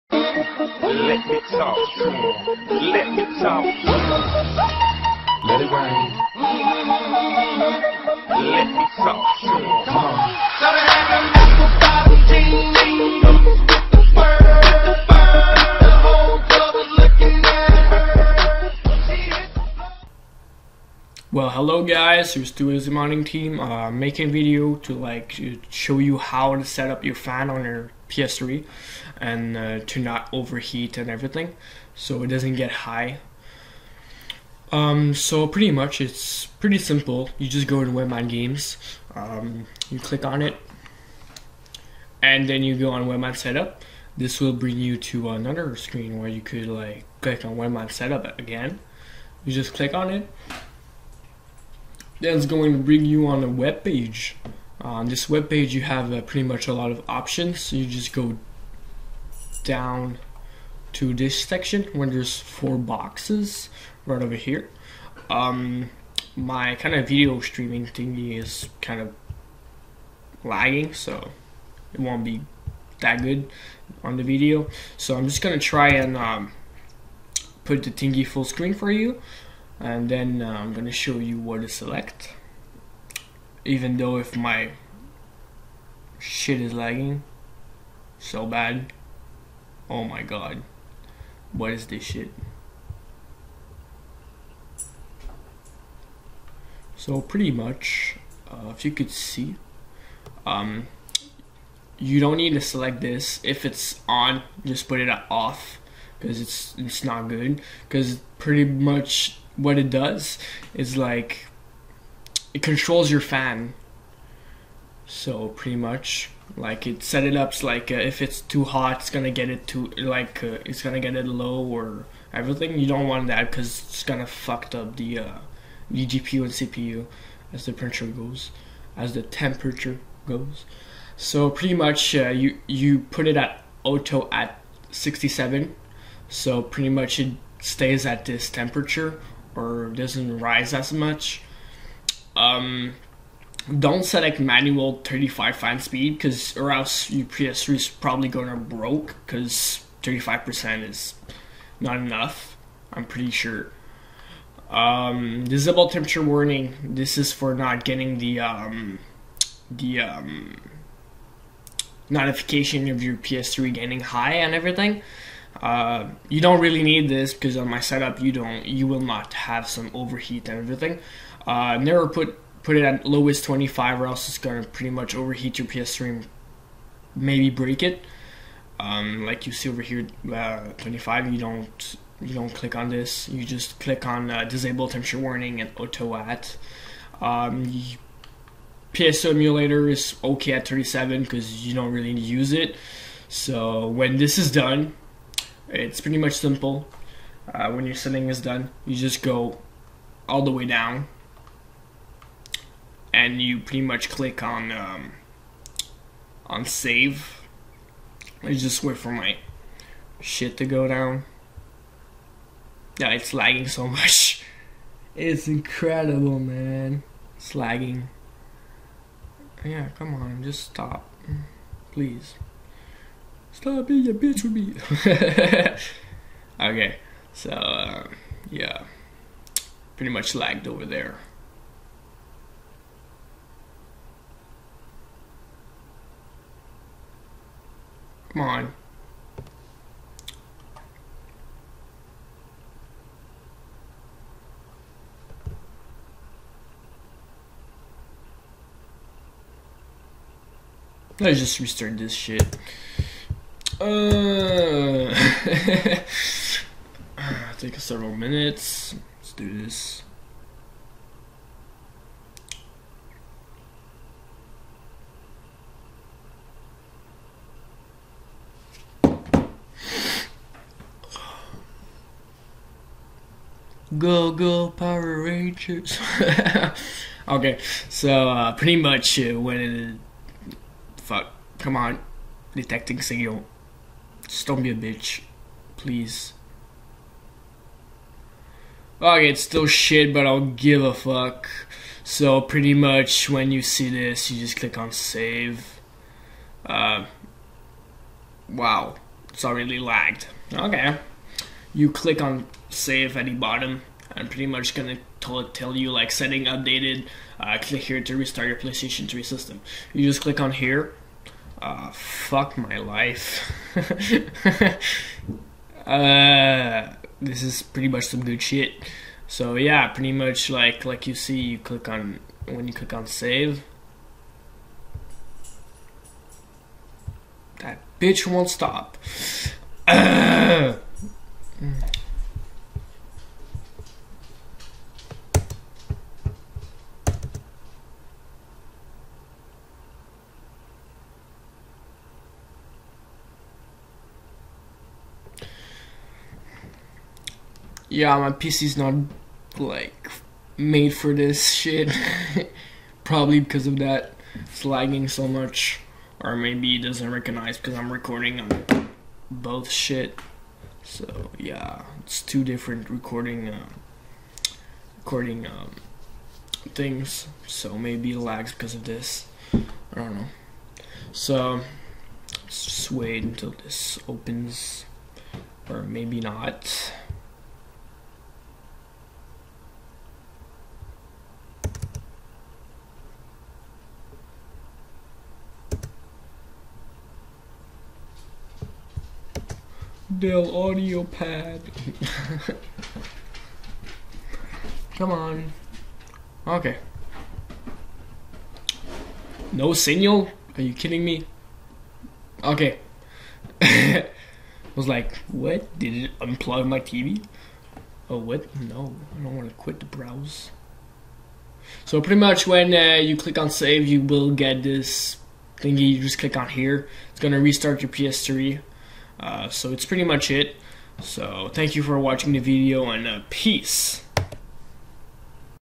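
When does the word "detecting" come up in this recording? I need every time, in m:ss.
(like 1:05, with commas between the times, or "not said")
4:42.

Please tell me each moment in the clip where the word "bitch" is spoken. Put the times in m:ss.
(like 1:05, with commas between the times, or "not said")
3:44, 4:44, 5:27.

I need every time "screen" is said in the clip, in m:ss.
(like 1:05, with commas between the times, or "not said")
0:45, 1:18.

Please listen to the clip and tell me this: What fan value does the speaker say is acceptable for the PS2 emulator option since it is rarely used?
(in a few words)
37.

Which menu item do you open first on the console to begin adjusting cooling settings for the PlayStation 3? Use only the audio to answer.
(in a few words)
webMAN Games.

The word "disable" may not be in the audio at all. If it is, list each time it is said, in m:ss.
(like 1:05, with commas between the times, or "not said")
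2:35, 3:04.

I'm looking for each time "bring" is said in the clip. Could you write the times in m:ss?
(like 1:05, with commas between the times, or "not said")
0:44, 0:52.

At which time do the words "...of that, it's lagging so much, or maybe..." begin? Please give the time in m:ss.
5:53.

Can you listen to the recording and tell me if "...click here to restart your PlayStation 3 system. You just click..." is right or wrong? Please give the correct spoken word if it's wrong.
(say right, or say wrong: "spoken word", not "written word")
right.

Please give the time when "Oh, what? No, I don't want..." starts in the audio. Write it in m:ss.
6:48.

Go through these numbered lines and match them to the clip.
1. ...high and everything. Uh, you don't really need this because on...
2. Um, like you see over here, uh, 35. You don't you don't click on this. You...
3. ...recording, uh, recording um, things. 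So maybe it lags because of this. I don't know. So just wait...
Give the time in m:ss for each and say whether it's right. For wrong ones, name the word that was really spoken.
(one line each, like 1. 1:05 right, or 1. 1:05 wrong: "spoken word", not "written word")
1. 2:43 right
2. 2:58 wrong: "25", not "35"
3. 6:02 right.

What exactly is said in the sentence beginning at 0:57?
So you just go down to this section where there's four boxes right over here.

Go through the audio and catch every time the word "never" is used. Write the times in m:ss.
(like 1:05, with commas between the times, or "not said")
2:51.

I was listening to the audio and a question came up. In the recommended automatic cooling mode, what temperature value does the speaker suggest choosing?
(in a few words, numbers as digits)
67.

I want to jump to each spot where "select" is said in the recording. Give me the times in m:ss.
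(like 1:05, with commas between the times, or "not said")
1:21, 1:42.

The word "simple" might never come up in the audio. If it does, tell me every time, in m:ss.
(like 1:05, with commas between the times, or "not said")
0:36, 3:16.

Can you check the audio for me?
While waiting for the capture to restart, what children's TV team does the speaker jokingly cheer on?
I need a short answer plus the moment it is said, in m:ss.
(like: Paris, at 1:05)
Power Rangers, at 4:34.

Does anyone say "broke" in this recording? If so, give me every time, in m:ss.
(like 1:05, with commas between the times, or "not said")
2:28.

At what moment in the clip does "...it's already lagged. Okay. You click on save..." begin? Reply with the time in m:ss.
4:59.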